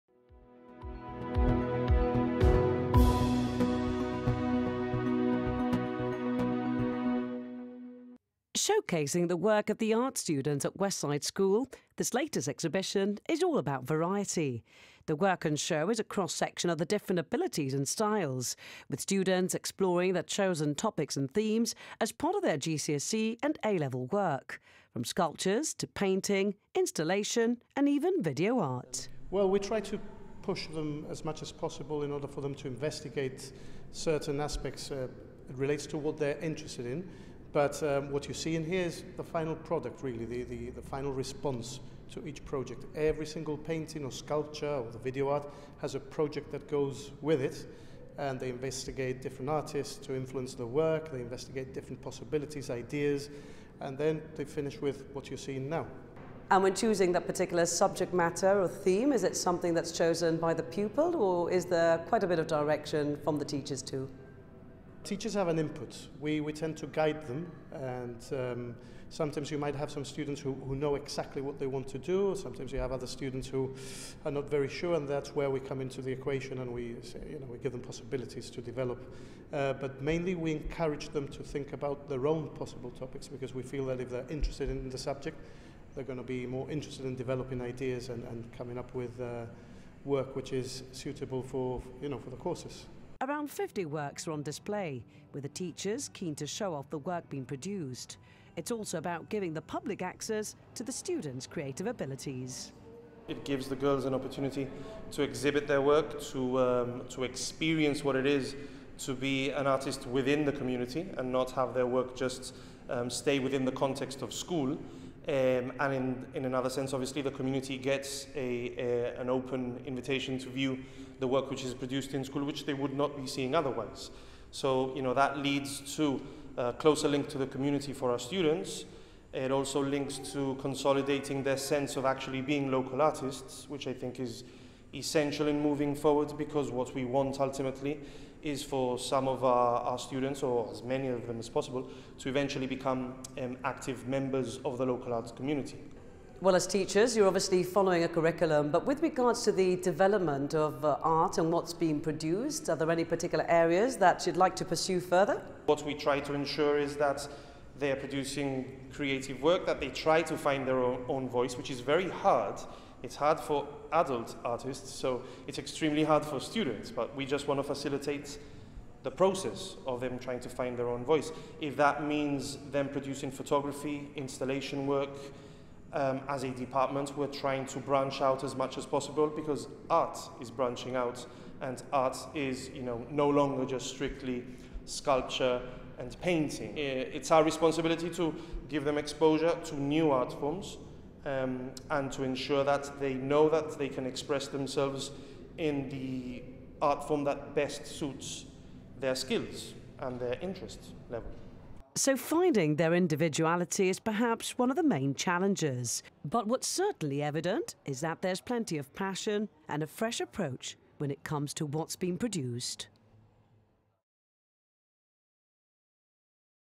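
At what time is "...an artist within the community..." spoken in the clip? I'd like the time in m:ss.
1:49.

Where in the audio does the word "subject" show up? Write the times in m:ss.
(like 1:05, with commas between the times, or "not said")
0:57, 1:24.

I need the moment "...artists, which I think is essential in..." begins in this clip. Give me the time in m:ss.
2:12.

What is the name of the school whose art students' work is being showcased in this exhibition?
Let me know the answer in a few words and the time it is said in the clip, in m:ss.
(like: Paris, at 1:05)
Westside School, at 0:10.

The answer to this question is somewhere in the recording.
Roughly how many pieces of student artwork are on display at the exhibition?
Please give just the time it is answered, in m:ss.
1:33.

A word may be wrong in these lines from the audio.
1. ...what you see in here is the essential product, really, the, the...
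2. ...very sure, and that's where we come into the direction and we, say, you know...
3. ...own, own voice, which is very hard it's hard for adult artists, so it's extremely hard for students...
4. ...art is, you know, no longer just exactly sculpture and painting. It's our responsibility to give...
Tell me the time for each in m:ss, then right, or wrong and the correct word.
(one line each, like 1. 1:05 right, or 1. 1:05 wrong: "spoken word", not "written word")
1. 0:38 wrong: "final", not "essential"
2. 1:14 wrong: "equation", not "direction"
3. 2:40 right
4. 3:01 wrong: "strictly", not "exactly".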